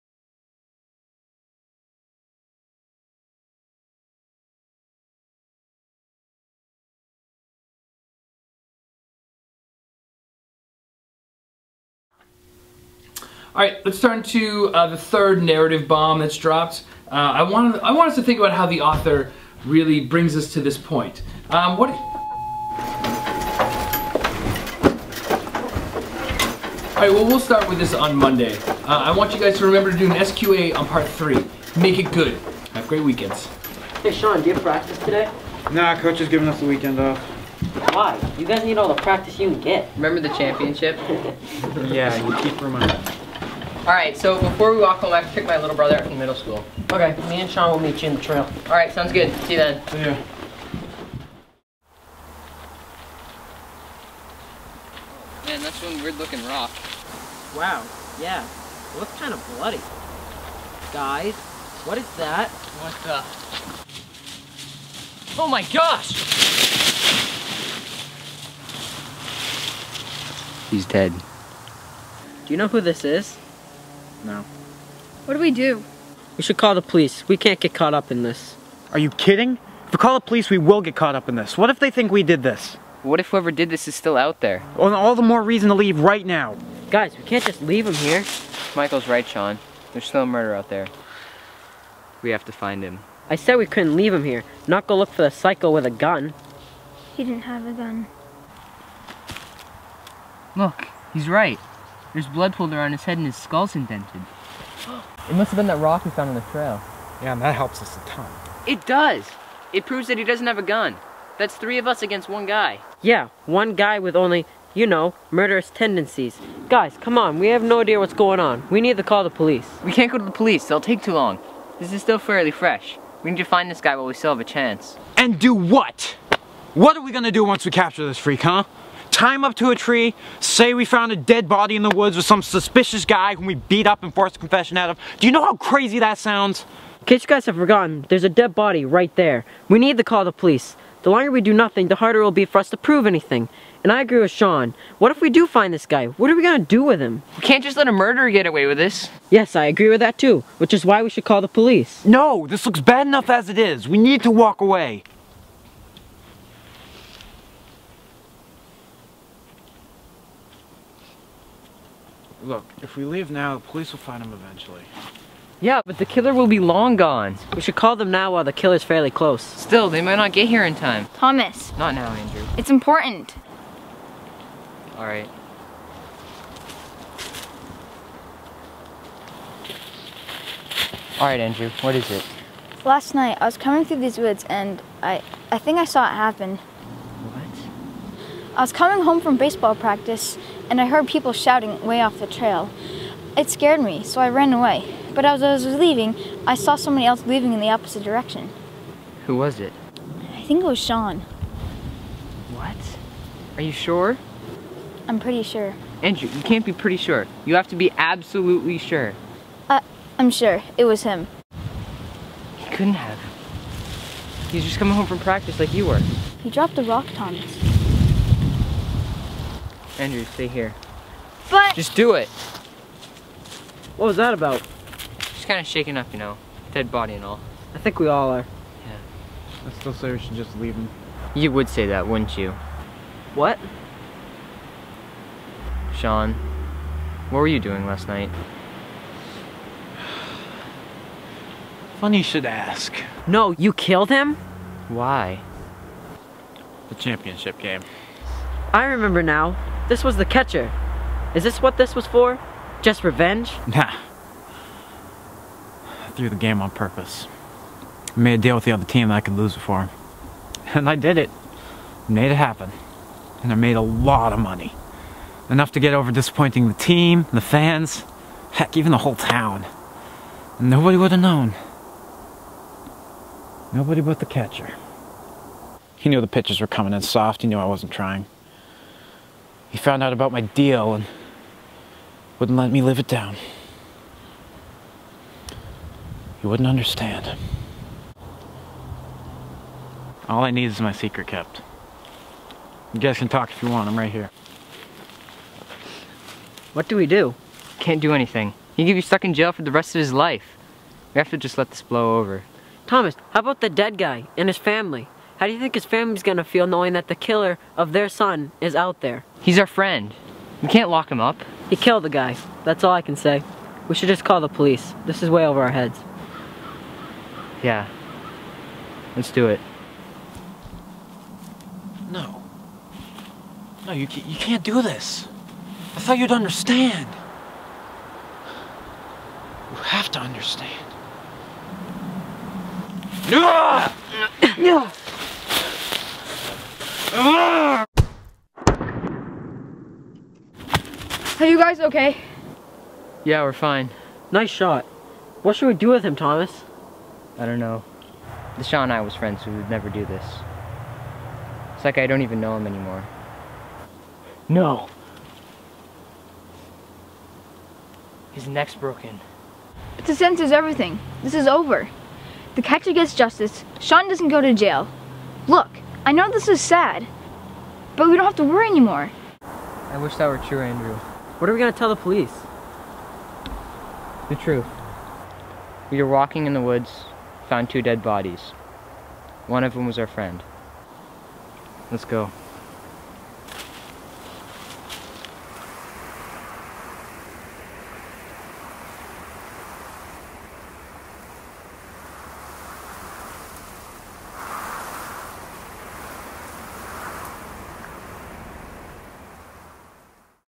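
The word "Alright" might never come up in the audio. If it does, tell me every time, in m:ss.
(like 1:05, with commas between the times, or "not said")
0:43, 0:48, 2:54, 3:01.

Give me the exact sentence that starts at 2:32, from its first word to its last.
No, this looks bad enough as it is.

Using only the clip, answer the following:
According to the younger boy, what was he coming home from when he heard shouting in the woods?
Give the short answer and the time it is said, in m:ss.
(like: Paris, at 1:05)
baseball practice, at 3:09.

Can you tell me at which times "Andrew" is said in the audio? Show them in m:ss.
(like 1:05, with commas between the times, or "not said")
2:52, 3:01, 3:26, 3:40, 6:10.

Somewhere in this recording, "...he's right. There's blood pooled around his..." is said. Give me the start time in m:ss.
1:41.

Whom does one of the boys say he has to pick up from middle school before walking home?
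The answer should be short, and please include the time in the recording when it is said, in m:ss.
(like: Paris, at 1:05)
little brother, at 0:45.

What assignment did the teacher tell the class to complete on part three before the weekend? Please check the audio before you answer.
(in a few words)
SQA.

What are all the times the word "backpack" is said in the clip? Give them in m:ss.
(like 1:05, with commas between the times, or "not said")
not said.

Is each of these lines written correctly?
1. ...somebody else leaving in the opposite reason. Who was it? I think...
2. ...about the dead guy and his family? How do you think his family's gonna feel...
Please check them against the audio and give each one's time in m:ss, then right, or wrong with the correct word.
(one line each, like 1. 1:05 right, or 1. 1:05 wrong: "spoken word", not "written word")
1. 3:16 wrong: "direction", not "reason"
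2. 5:03 right.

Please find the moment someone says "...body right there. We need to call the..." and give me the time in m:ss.
2:18.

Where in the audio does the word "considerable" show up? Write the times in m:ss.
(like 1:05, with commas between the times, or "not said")
not said.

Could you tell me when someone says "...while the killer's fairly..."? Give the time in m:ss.
2:48.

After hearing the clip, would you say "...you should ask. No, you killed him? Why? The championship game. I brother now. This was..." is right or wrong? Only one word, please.
wrong.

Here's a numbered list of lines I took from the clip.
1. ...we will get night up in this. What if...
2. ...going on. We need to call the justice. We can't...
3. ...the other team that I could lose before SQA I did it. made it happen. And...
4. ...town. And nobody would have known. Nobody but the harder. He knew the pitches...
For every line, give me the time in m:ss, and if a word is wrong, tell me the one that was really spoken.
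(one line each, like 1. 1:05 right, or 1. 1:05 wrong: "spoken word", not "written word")
1. 1:20 wrong: "caught", not "night"
2. 1:58 wrong: "police", not "justice"
3. 4:18 wrong: "And", not "SQA"
4. 4:29 wrong: "catcher", not "harder".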